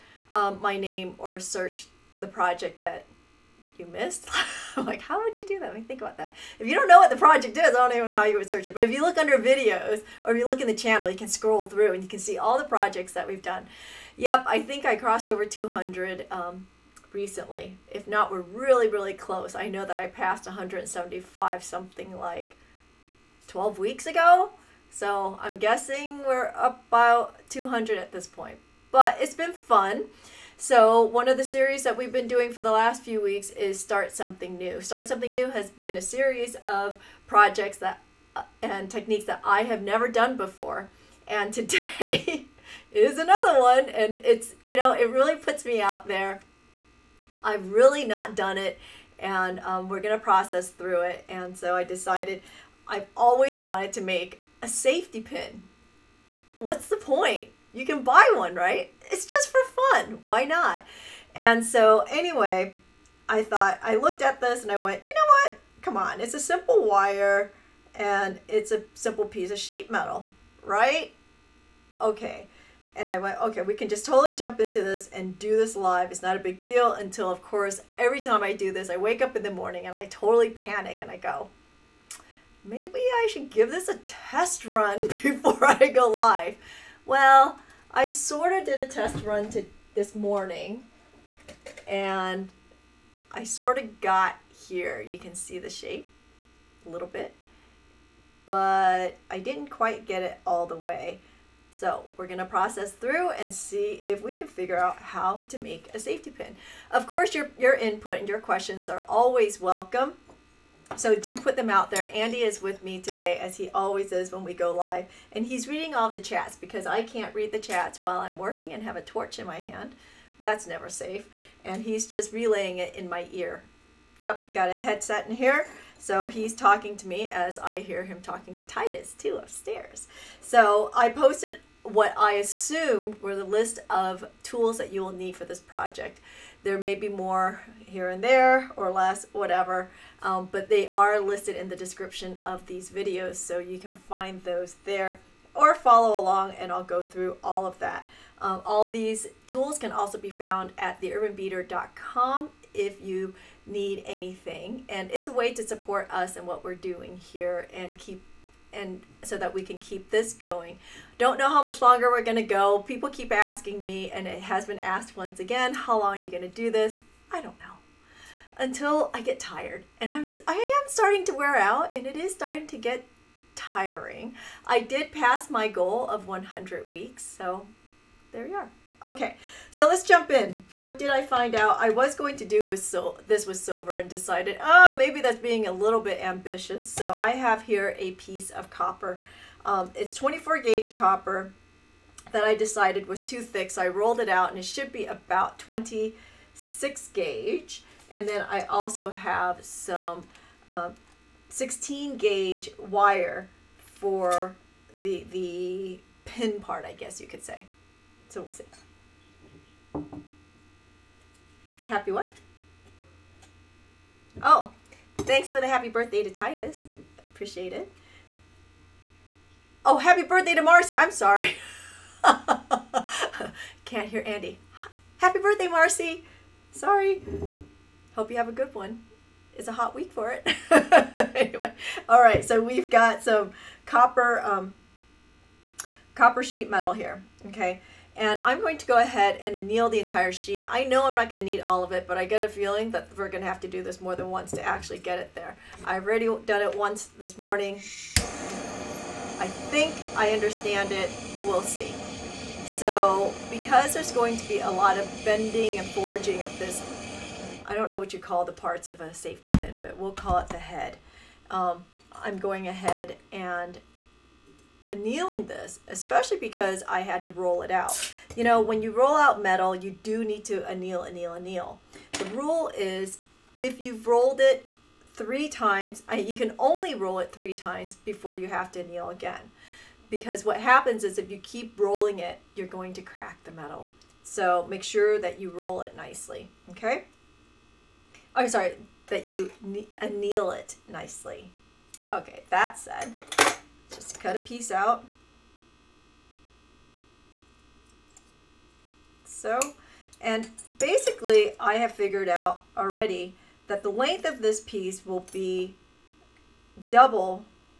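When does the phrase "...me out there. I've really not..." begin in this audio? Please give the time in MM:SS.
00:45.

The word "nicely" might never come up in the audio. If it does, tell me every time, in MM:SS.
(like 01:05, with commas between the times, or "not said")
04:45, 04:50.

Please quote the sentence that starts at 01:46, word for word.
Of course, your, your input and your questions are always welcome.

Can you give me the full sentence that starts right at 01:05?
Come on, it's a simple wire and it's a simple piece of sheet metal, right?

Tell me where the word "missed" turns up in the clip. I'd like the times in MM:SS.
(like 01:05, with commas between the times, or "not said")
00:03.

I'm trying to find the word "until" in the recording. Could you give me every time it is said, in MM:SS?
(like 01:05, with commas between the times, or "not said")
01:16, 02:48.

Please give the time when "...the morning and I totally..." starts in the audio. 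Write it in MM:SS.
01:19.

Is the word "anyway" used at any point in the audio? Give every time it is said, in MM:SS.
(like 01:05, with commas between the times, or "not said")
01:02, 03:51.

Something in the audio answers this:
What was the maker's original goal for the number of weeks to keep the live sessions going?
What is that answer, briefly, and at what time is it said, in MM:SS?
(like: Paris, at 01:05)
100 weeks, at 02:56.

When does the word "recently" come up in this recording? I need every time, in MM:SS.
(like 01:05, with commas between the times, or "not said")
00:17.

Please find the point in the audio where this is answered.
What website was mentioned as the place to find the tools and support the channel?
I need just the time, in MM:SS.
02:31.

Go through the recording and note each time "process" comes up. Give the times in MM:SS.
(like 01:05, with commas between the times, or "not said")
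00:50, 01:42.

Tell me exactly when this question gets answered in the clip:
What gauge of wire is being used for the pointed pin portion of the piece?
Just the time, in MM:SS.
03:21.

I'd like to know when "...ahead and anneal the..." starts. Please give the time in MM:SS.
03:58.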